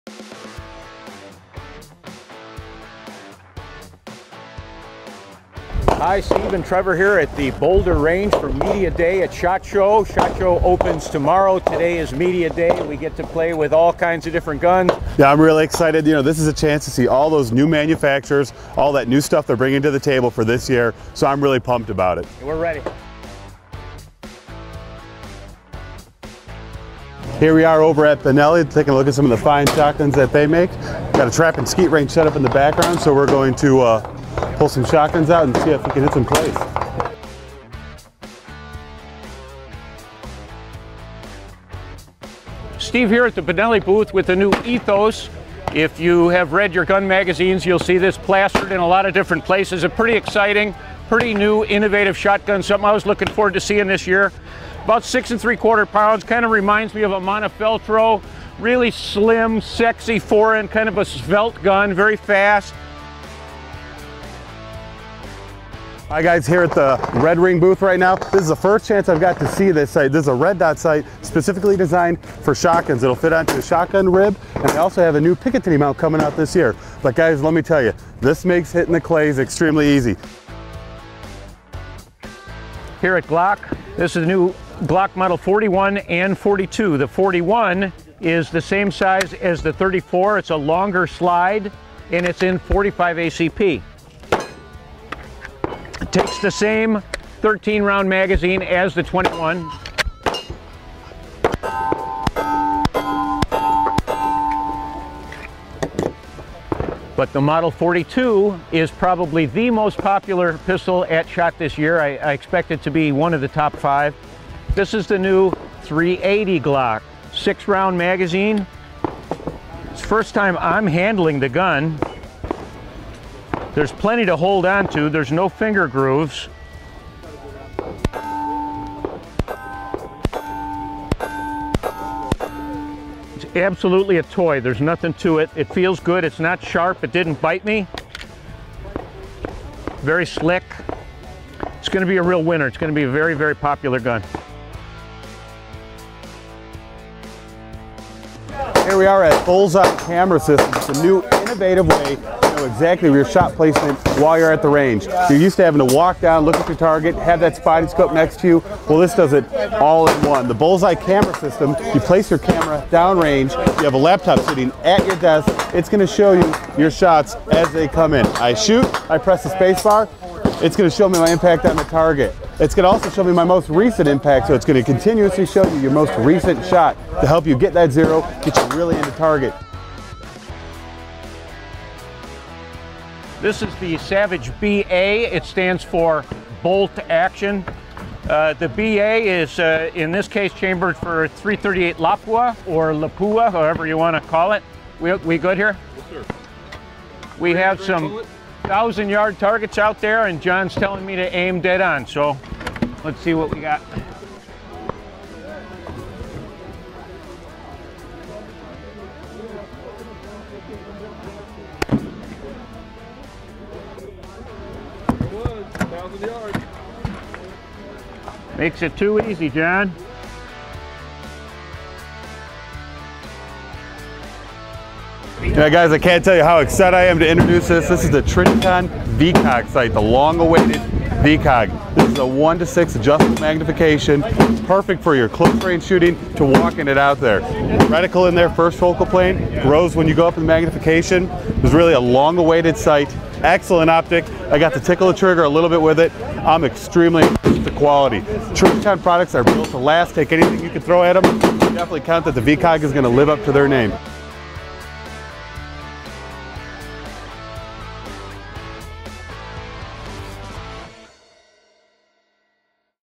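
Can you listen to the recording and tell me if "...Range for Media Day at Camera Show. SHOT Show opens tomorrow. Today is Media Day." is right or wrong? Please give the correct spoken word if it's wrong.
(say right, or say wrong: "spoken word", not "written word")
wrong: "SHOT", not "Camera".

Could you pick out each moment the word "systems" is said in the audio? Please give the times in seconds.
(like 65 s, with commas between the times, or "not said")
150 s, 161 s.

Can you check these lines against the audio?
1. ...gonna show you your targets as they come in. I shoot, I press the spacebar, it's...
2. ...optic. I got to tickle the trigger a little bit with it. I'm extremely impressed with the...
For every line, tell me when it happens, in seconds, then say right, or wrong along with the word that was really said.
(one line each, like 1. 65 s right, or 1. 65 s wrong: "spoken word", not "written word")
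1. 165 s wrong: "shots", not "targets"
2. 243 s right.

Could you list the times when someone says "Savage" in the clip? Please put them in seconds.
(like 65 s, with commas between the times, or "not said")
183 s.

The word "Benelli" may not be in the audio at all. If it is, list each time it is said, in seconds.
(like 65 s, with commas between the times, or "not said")
28 s, 43 s.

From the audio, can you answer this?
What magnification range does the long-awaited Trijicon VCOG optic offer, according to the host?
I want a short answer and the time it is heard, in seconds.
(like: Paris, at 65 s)
1 to 6, at 232 s.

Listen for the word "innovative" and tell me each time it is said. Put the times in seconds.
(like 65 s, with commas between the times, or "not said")
51 s, 151 s.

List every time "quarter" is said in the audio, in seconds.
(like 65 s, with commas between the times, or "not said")
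55 s.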